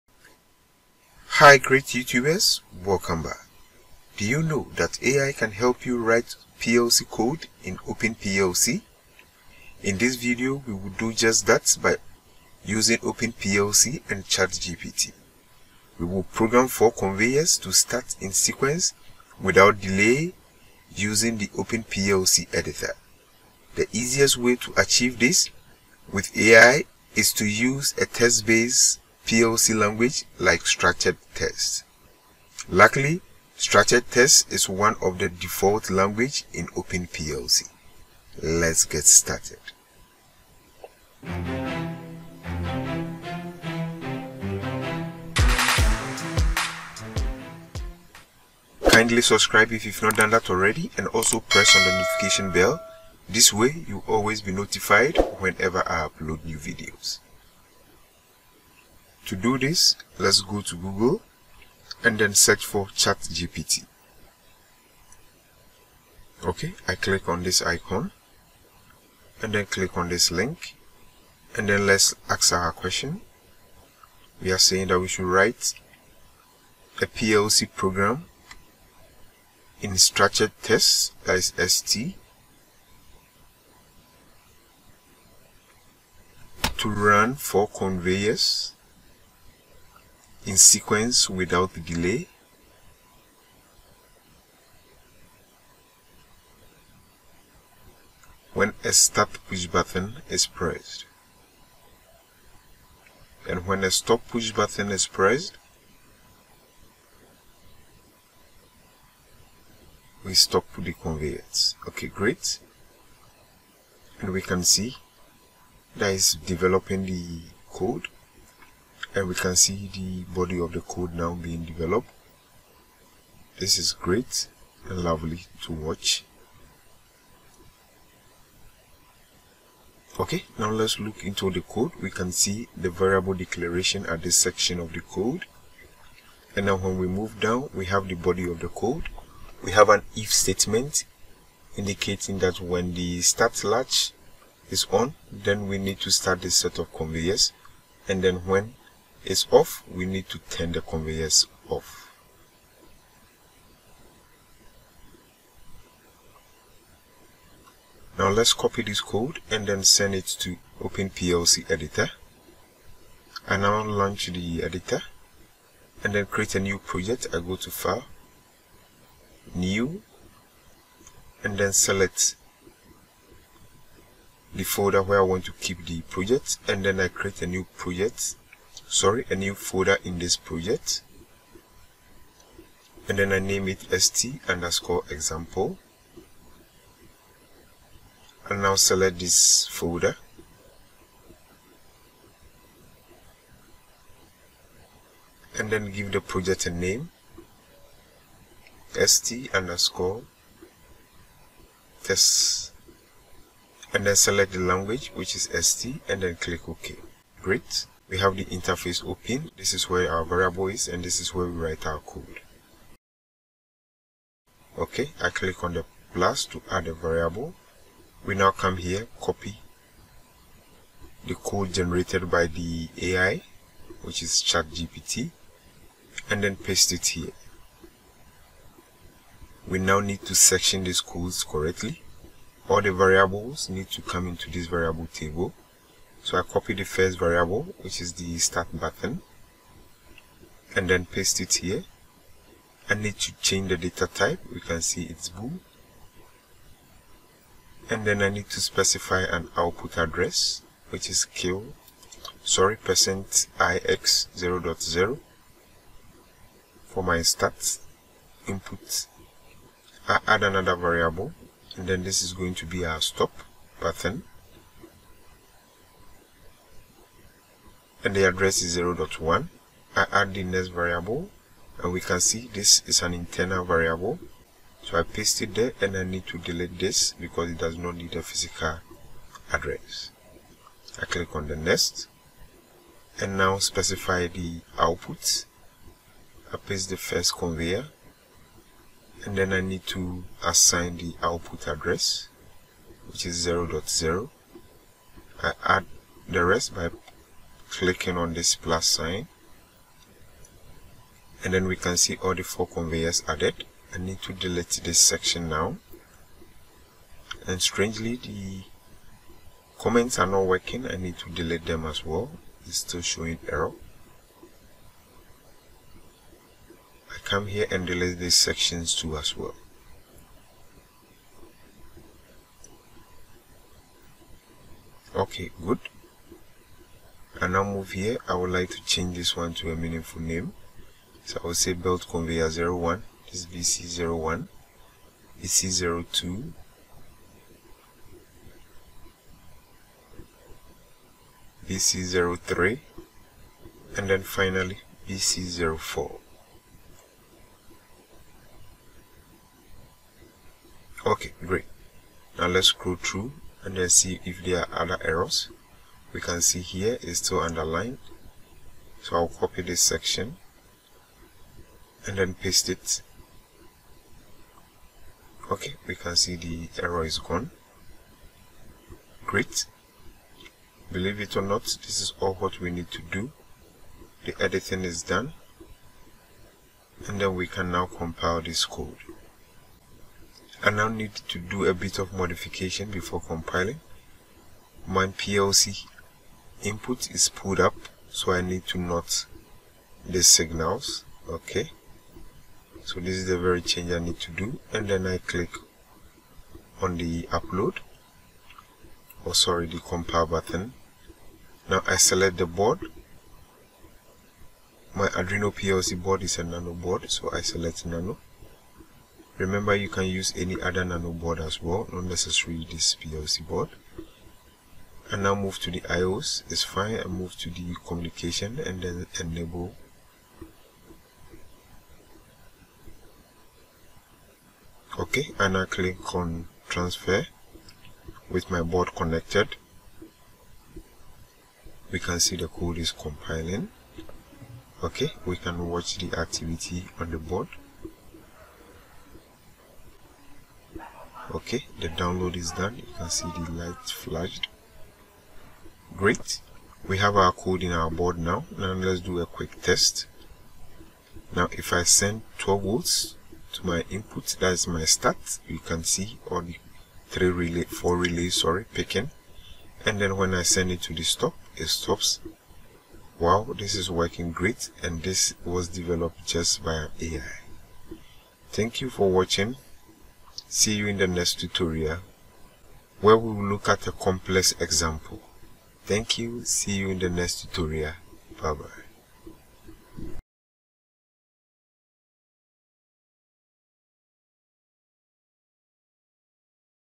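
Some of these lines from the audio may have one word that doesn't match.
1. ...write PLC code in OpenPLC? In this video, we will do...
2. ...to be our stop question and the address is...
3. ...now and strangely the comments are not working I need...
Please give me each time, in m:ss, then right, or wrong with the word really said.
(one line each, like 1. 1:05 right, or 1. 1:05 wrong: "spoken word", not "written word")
1. 0:05 right
2. 4:22 wrong: "button", not "question"
3. 5:05 right.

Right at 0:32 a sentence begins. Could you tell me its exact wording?
Luckily, structured text is one of the default language in OpenPLC.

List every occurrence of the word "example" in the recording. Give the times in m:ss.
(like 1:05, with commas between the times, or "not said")
3:05, 7:54.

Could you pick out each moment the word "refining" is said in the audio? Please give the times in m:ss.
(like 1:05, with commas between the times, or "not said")
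not said.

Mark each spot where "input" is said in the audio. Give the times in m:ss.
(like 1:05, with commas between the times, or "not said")
4:18, 6:26, 7:33.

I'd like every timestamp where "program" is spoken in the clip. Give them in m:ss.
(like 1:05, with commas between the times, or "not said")
0:16, 1:17.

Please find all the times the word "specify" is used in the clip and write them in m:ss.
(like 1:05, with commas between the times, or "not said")
4:08, 4:43.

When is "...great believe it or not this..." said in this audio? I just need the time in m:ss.
6:09.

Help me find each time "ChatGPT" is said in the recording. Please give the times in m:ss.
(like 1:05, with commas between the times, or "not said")
0:14, 1:02, 3:44.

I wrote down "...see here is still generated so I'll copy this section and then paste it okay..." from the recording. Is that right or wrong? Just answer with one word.
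wrong.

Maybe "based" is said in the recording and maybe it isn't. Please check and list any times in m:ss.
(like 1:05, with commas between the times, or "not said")
0:28.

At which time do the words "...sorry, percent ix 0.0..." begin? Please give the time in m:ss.
4:12.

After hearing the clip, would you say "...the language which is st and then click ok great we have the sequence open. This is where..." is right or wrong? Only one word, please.
wrong.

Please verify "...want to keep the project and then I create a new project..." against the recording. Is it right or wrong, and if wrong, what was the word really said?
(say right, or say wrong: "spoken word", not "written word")
right.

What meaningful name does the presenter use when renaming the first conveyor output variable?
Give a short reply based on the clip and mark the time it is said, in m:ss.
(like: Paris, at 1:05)
belt conveyor 01, at 5:31.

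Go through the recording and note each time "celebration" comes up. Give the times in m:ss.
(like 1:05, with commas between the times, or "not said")
not said.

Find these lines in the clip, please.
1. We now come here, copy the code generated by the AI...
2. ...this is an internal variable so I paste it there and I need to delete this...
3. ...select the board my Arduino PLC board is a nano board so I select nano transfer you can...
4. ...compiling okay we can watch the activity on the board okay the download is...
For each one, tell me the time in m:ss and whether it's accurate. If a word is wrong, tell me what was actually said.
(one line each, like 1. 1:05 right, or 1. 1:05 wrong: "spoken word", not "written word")
1. 3:38 right
2. 4:32 right
3. 6:41 wrong: "remember", not "transfer"
4. 7:12 right.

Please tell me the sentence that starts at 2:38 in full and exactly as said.
Now let's copy this code and then send it to Open PLC Editor.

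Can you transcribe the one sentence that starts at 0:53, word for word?
This way you will always be notified whenever I upload new videos.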